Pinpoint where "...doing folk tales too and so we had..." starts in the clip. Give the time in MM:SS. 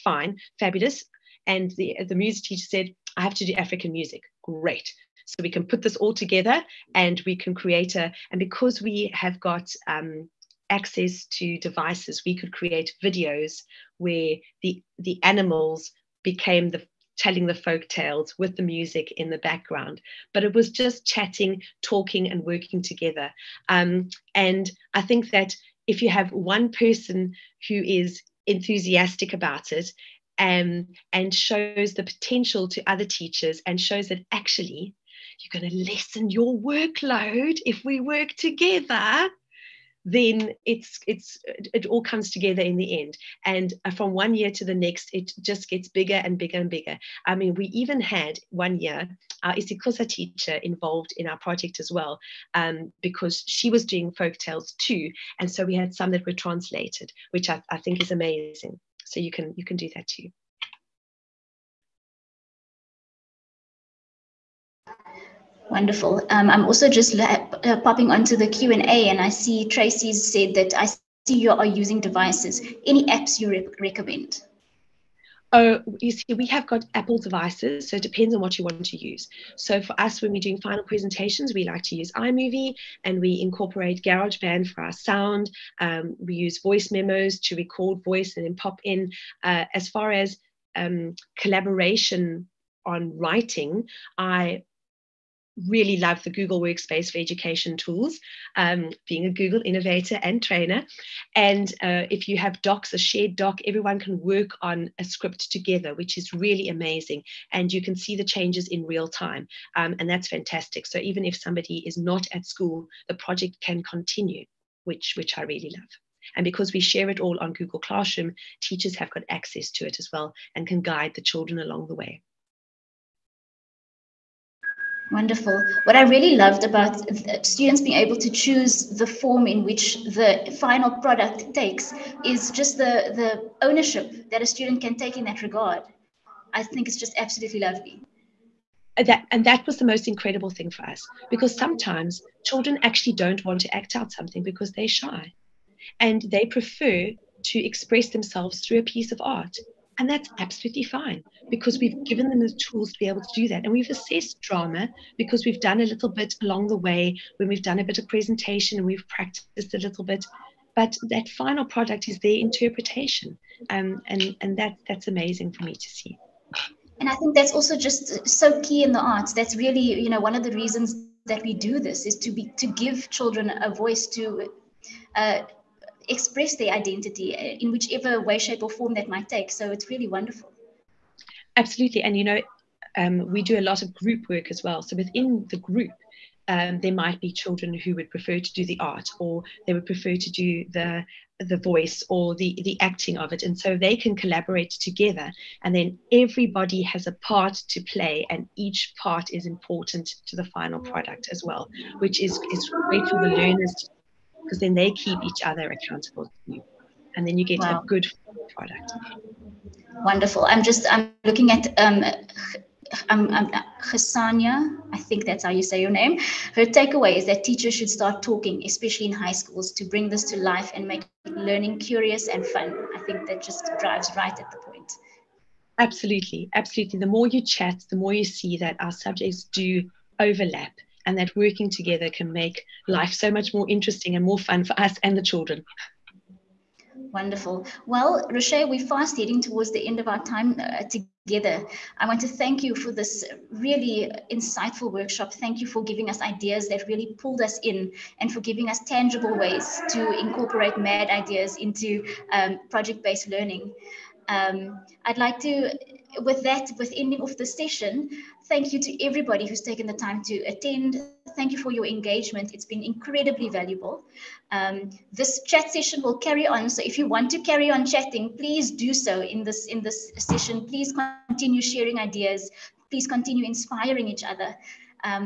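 00:53.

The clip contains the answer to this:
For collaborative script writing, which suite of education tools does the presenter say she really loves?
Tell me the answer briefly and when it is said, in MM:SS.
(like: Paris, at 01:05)
Google Workspace for Education, at 01:36.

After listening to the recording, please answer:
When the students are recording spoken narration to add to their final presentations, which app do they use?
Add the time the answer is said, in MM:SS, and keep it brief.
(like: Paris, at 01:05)
Voice Memos, at 01:26.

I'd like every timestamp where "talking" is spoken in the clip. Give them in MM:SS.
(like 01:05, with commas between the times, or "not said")
00:21, 03:38.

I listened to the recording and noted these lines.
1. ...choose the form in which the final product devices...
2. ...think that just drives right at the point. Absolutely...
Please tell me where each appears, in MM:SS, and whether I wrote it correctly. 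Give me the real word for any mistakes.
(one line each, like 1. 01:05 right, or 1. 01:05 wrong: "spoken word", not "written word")
1. 02:08 wrong: "takes", not "devices"
2. 03:42 right.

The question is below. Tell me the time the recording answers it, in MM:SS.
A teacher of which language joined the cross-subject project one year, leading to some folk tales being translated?
00:49.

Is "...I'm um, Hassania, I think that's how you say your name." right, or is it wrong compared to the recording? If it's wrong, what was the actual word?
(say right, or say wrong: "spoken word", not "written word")
right.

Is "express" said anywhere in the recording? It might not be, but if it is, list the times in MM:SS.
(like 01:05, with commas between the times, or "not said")
02:27, 02:56.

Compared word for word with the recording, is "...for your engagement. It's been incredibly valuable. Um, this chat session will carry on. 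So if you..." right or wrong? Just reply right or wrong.
right.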